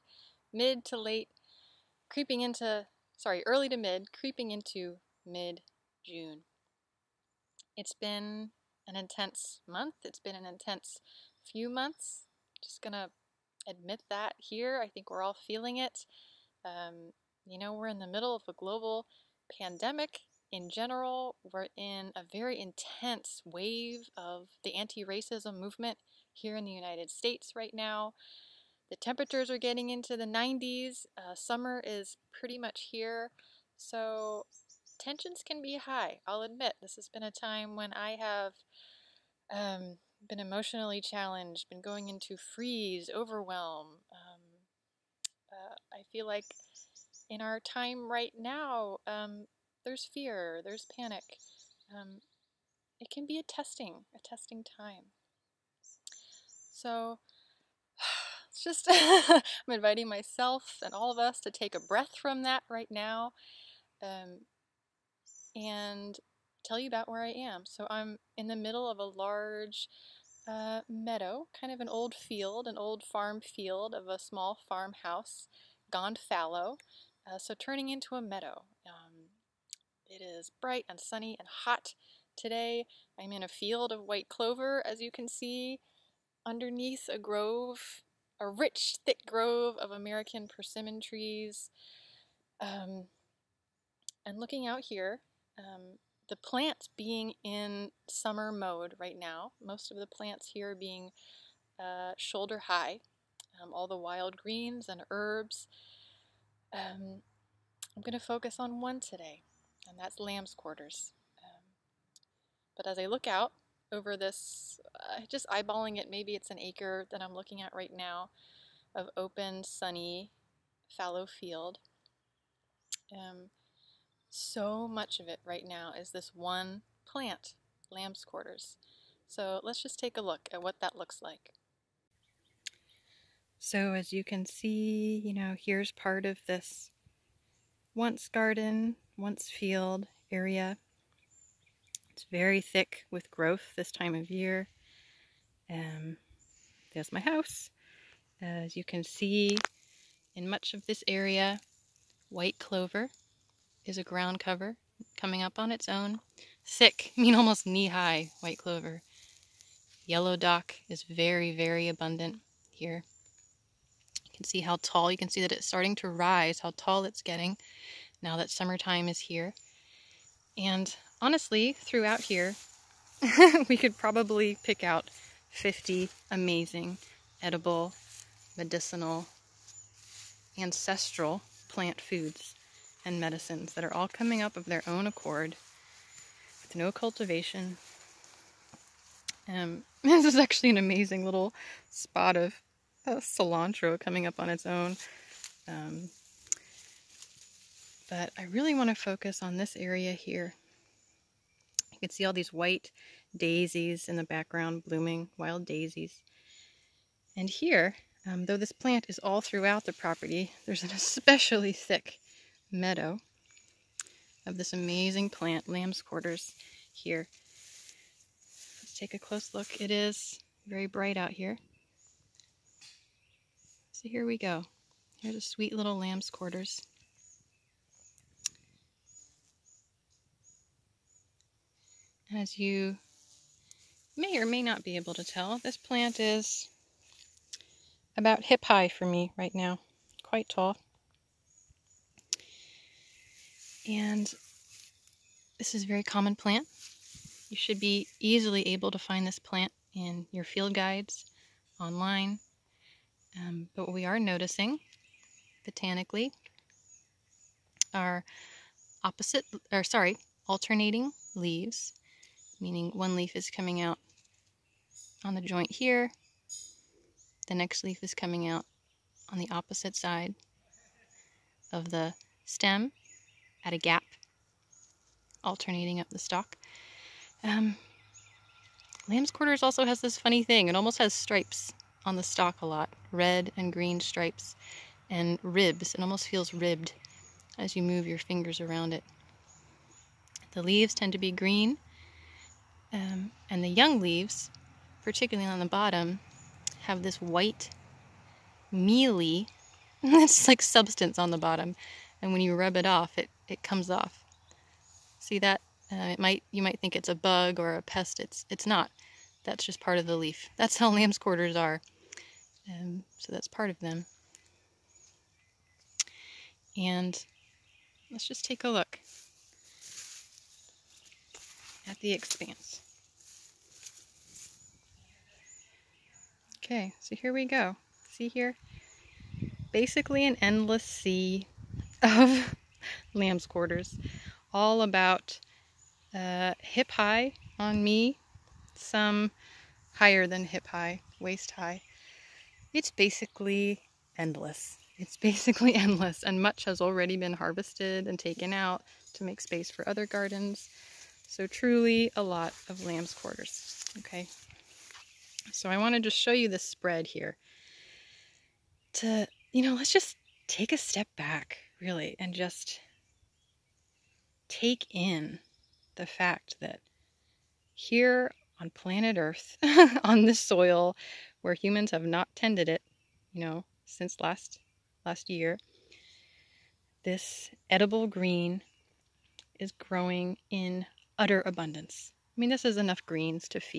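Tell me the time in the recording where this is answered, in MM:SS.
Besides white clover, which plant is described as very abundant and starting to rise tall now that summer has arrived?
02:40.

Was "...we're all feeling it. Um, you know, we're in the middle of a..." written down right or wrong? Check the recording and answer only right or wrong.
right.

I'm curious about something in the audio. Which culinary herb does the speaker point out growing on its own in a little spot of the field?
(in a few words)
cilantro.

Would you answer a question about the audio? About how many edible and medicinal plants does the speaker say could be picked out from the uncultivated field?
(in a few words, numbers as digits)
50.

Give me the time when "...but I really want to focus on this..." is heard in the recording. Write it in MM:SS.
03:18.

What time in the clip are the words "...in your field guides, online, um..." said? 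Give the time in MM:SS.
04:09.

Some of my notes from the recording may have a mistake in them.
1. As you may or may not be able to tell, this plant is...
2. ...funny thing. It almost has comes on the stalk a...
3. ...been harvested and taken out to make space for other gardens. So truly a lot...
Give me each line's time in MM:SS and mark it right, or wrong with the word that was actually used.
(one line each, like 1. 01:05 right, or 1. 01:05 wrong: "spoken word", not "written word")
1. 03:52 right
2. 04:40 wrong: "stripes", not "comes"
3. 05:47 right.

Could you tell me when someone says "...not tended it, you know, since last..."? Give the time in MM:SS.
06:12.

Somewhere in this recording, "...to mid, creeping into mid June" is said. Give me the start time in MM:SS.
00:03.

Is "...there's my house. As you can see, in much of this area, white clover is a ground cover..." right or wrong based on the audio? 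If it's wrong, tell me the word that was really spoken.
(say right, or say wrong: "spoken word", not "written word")
right.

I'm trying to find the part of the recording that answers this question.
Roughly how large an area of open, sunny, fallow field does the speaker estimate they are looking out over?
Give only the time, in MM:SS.
01:56.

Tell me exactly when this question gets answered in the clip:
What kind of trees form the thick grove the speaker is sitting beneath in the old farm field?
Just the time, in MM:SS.
01:29.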